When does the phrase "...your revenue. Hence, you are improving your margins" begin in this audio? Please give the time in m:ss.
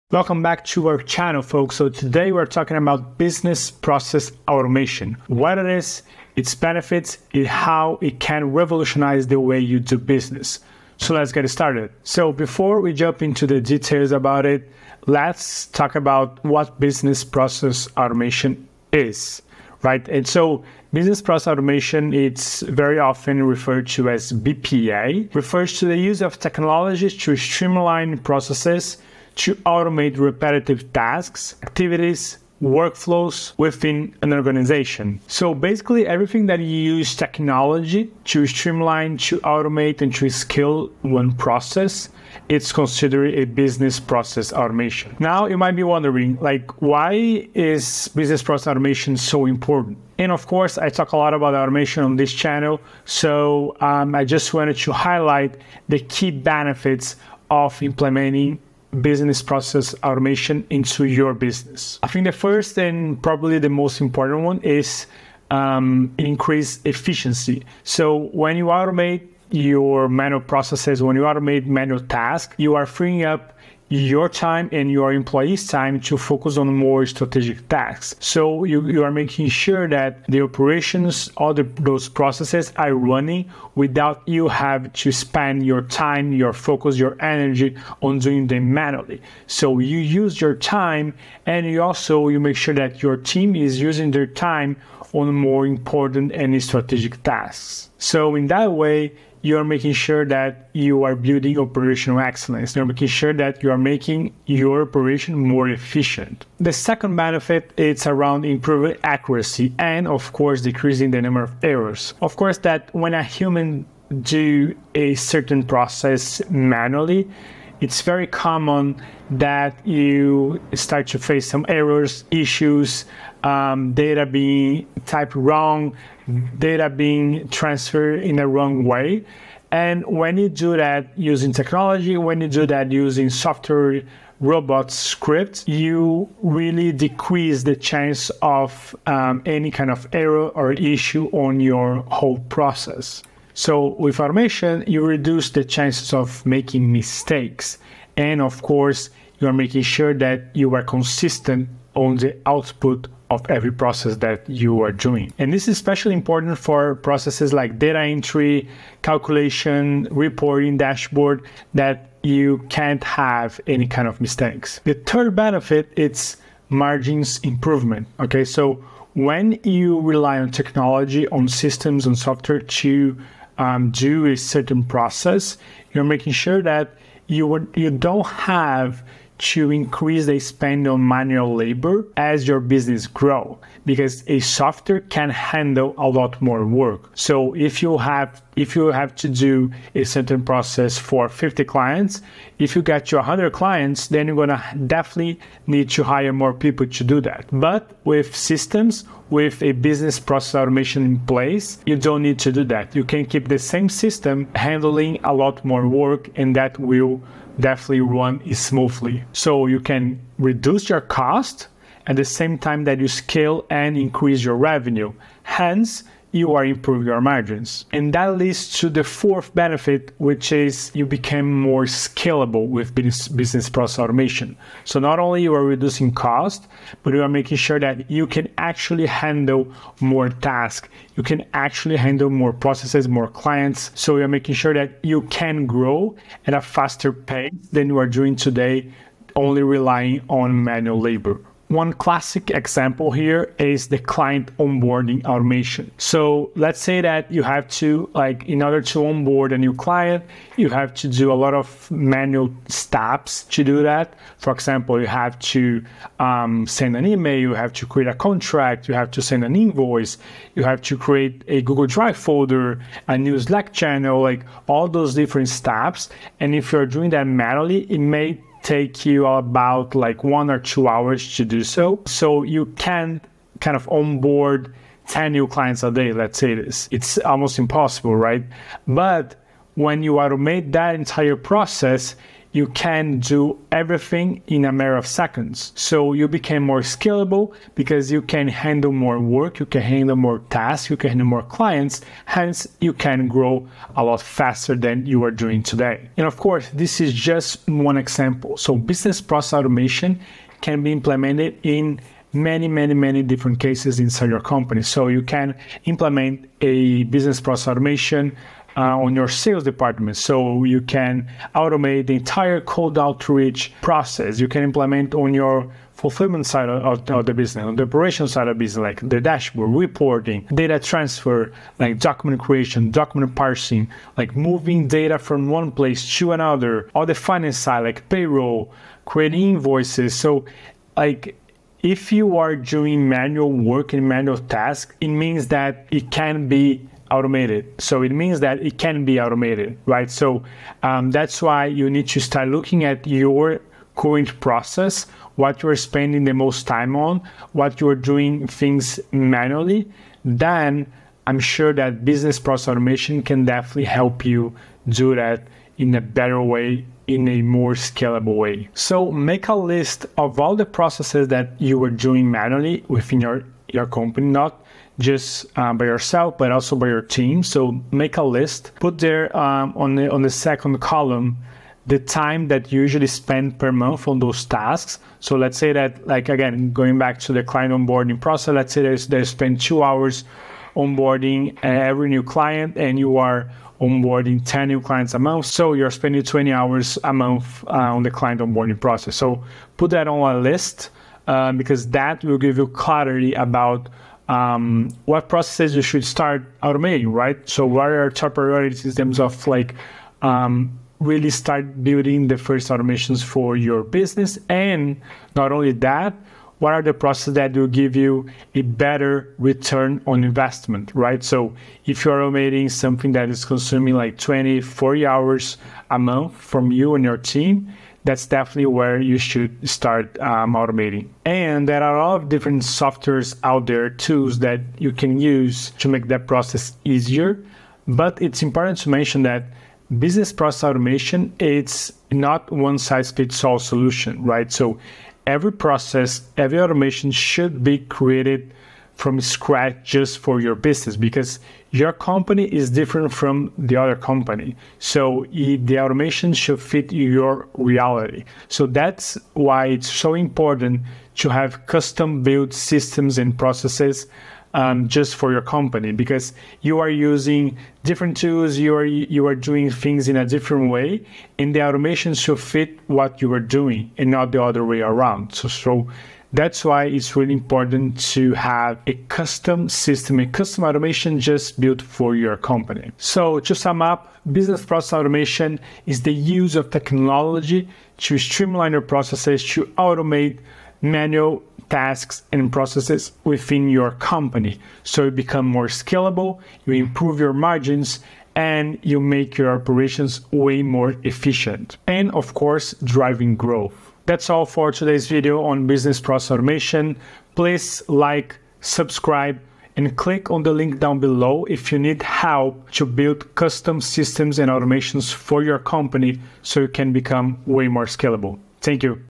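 3:34.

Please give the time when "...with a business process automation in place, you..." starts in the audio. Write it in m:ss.
3:19.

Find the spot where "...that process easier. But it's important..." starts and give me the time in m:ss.
7:06.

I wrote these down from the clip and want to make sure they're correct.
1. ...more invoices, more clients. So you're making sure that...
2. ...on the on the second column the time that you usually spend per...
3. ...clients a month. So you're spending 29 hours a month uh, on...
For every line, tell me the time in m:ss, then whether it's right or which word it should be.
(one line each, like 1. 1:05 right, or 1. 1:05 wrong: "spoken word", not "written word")
1. 3:52 wrong: "processes", not "invoices"
2. 6:09 right
3. 6:24 wrong: "20", not "29".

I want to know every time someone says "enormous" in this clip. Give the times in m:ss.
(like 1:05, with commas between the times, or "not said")
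not said.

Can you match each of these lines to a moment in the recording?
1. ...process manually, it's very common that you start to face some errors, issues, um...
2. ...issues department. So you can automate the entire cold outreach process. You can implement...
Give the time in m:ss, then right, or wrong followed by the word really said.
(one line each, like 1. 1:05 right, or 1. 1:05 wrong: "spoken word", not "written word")
1. 1:55 right
2. 5:09 wrong: "sales", not "issues".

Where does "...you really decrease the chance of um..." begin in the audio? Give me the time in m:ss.
2:15.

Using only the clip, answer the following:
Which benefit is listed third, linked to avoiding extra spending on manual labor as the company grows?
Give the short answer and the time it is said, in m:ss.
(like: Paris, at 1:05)
Margins improvement, at 2:46.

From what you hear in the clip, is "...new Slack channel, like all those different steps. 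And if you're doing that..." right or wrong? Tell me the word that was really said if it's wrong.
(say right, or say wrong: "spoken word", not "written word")
right.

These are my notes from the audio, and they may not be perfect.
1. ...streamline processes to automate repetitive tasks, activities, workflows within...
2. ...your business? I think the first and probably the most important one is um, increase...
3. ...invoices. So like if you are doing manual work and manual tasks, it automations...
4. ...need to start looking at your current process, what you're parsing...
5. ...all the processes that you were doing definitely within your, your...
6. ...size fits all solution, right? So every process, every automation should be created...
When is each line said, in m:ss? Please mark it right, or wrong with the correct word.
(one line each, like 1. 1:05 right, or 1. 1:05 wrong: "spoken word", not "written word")
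1. 0:27 right
2. 1:01 right
3. 5:29 wrong: "means", not "automations"
4. 5:41 wrong: "spending", not "parsing"
5. 6:00 wrong: "manually", not "definitely"
6. 7:12 right.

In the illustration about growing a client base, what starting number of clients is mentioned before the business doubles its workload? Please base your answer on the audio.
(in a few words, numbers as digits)
50.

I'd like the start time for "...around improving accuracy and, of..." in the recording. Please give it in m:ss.
1:48.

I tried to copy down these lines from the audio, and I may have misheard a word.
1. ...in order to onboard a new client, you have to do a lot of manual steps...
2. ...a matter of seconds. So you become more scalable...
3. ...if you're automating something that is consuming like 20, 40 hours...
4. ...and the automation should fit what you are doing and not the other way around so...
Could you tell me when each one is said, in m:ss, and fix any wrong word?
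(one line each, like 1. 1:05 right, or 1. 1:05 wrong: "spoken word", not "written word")
1. 4:08 right
2. 4:44 right
3. 6:51 right
4. 7:41 right.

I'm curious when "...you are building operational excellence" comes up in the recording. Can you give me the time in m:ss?
1:40.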